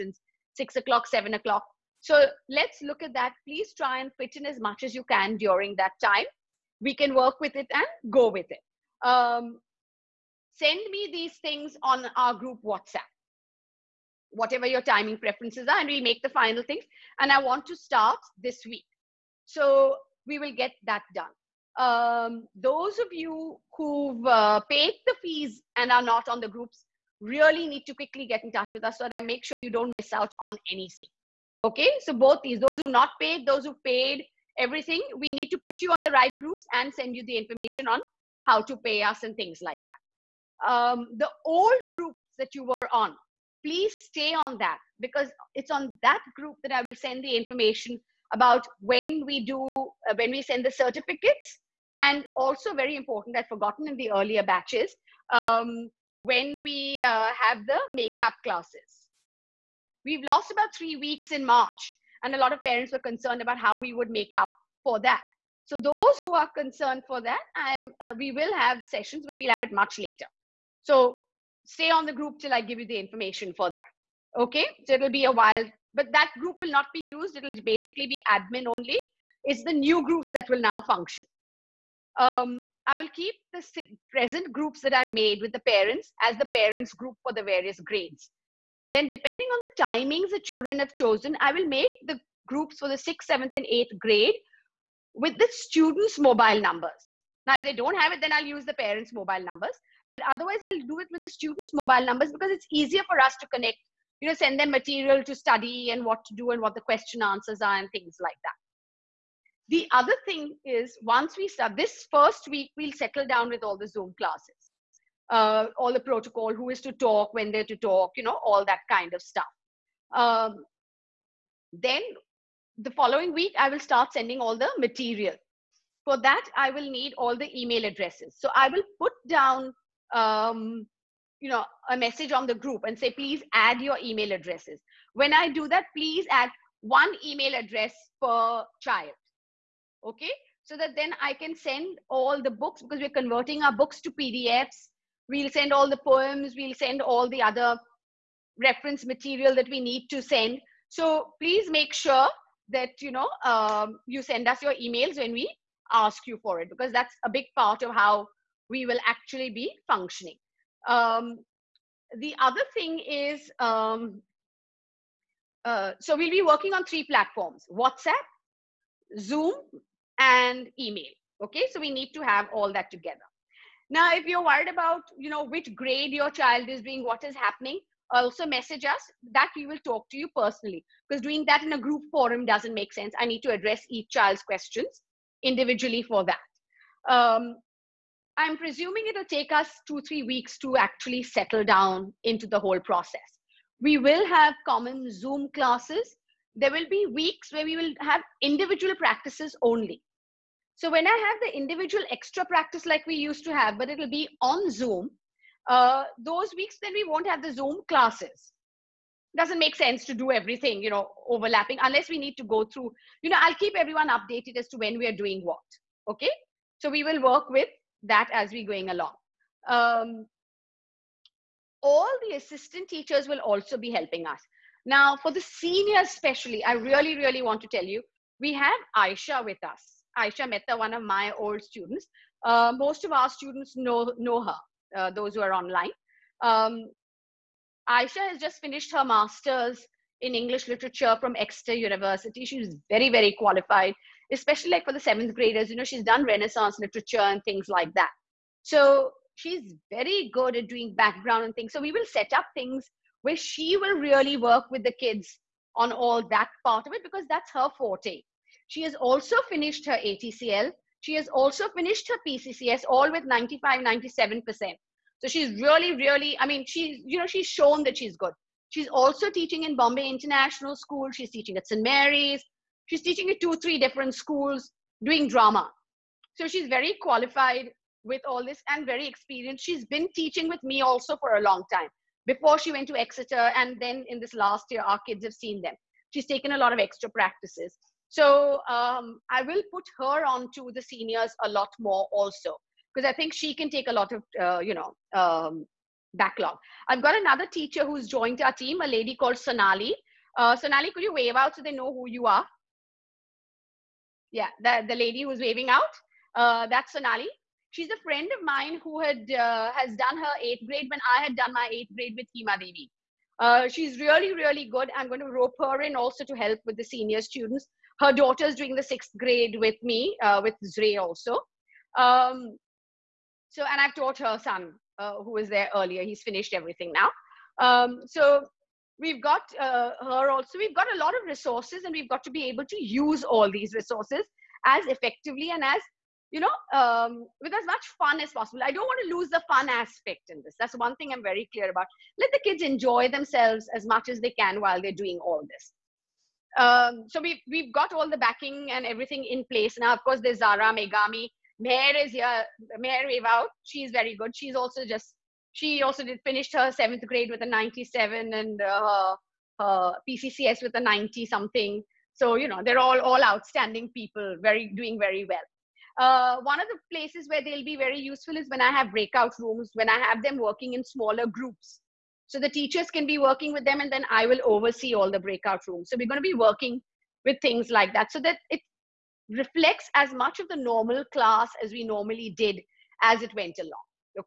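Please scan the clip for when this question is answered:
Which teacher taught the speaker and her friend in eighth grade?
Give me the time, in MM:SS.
05:12.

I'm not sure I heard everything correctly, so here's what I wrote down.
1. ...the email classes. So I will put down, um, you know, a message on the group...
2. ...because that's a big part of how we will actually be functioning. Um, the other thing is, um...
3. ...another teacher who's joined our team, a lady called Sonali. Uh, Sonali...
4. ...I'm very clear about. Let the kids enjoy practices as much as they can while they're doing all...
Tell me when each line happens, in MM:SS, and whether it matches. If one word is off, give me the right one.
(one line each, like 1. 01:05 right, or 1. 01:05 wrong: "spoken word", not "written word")
1. 02:07 wrong: "addresses", not "classes"
2. 02:36 right
3. 04:57 right
4. 05:41 wrong: "themselves", not "practices".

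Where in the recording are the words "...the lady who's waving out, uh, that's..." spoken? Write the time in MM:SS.
05:04.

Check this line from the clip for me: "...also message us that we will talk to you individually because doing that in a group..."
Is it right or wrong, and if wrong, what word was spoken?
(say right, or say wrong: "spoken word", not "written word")
wrong: "personally", not "individually".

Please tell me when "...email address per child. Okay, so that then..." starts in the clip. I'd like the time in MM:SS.
02:17.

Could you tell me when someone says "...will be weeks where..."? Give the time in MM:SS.
03:16.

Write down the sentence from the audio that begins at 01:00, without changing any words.
We've lost about three weeks in March, and a lot of parents were concerned about how we would make up for that.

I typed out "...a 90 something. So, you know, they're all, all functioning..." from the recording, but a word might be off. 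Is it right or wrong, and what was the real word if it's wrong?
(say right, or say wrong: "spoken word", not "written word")
wrong: "outstanding", not "functioning".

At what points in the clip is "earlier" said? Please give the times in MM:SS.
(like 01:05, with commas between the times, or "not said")
00:54, 05:25.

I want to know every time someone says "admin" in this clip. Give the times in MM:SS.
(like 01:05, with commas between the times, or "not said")
01:18.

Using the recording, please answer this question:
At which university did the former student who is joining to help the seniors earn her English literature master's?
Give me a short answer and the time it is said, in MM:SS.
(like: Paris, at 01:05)
Exeter University, at 04:01.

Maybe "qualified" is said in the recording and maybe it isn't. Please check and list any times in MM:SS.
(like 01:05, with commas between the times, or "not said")
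04:03, 04:37.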